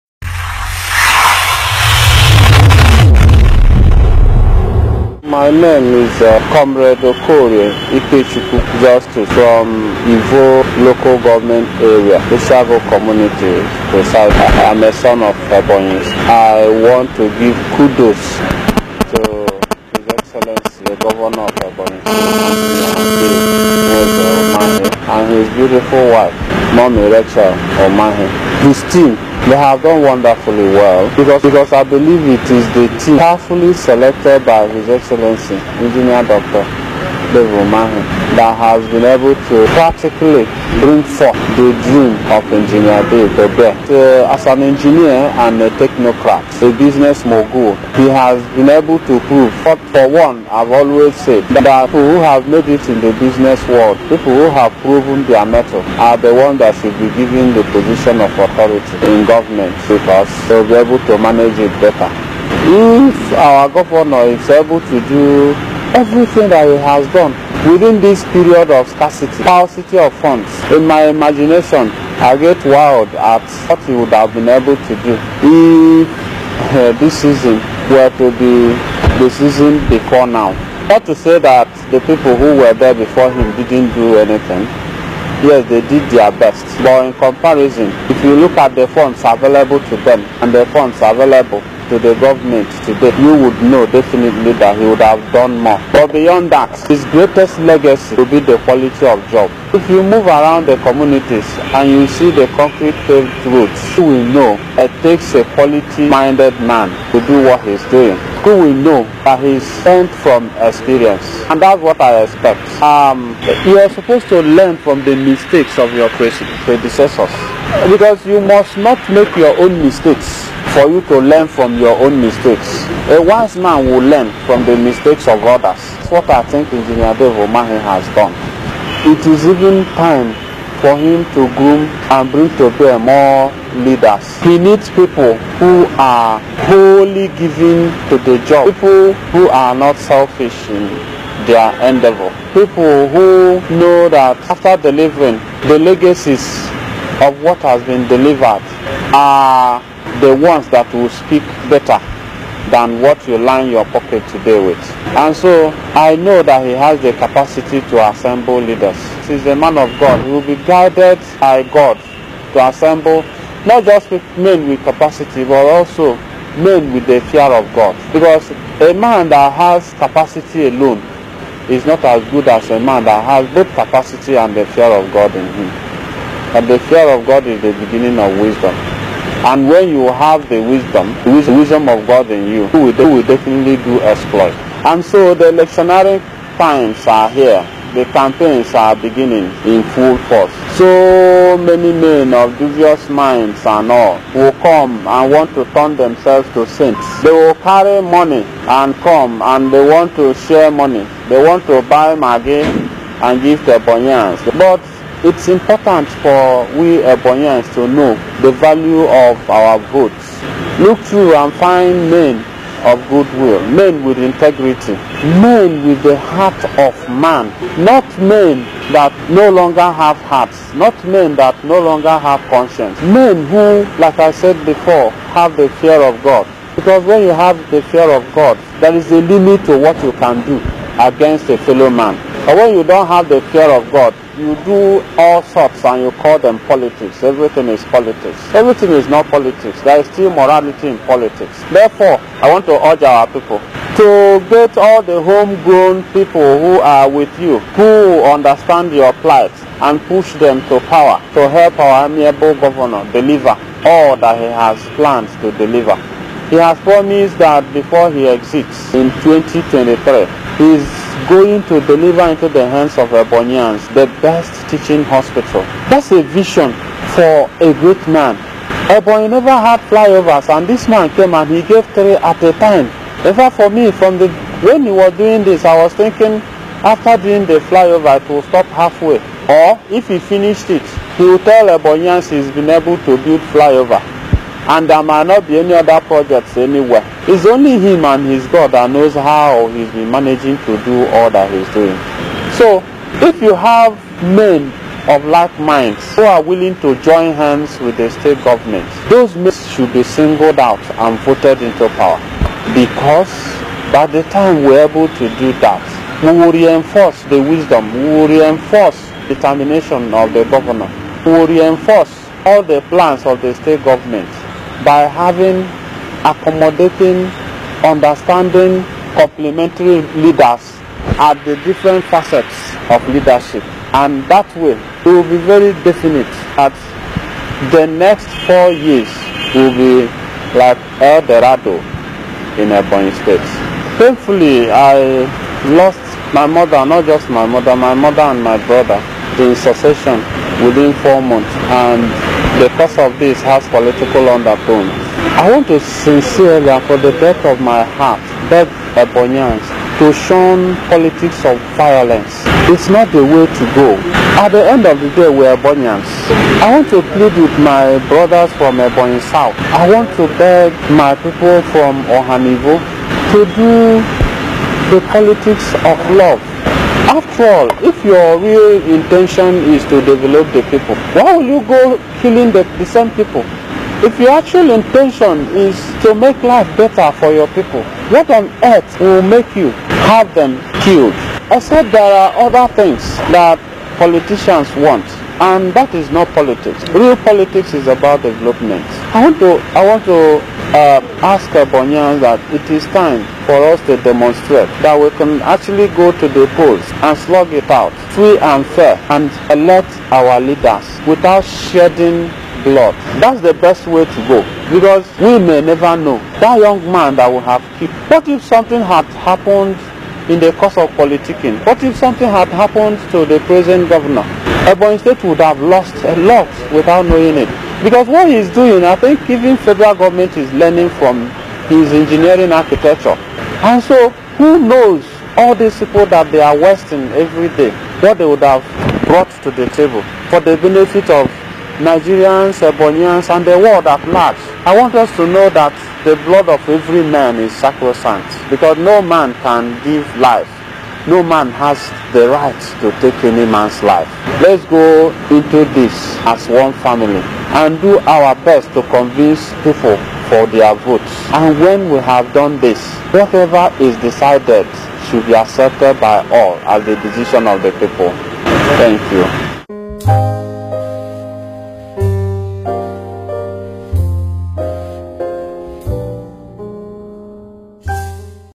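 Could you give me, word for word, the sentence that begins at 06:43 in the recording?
That's the best way to go because we may never know that young man that we have killed.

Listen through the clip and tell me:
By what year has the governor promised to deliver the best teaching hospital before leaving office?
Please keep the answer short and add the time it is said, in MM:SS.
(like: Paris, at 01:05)
2023, at 04:19.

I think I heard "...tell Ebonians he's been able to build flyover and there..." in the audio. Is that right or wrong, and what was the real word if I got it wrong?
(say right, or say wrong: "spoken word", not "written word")
right.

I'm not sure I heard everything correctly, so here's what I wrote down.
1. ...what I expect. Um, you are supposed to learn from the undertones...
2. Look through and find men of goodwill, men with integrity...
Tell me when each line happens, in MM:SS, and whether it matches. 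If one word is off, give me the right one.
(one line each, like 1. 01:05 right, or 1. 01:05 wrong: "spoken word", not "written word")
1. 01:51 wrong: "mistakes", not "undertones"
2. 03:30 right.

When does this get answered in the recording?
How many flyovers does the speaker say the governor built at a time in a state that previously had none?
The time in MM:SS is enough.
04:31.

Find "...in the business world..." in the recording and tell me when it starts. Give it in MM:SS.
00:52.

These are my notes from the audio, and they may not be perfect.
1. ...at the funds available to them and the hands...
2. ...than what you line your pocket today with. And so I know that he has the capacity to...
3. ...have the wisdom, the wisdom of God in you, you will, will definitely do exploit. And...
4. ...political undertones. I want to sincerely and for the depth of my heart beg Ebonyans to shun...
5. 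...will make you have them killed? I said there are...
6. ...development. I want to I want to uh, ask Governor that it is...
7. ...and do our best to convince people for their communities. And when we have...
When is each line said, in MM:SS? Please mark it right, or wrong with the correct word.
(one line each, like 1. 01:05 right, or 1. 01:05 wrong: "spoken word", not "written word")
1. 01:28 wrong: "funds", not "hands"
2. 02:32 right
3. 03:00 right
4. 05:43 right
5. 06:18 right
6. 06:28 wrong: "Abonyan", not "Governor"
7. 07:27 wrong: "votes", not "communities".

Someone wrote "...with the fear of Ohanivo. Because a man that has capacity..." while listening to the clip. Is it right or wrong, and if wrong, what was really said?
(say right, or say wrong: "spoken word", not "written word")
wrong: "God", not "Ohanivo".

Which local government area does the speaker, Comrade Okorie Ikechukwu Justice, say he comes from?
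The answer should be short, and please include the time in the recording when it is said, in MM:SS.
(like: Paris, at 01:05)
Ivo, at 00:10.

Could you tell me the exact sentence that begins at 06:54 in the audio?
Ebonyi State would have lost a lot without knowing it.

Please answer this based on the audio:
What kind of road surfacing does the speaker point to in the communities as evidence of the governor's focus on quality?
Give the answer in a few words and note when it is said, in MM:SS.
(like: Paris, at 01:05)
concrete paved roads, at 01:42.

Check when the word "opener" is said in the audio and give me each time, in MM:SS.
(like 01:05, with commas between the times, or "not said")
not said.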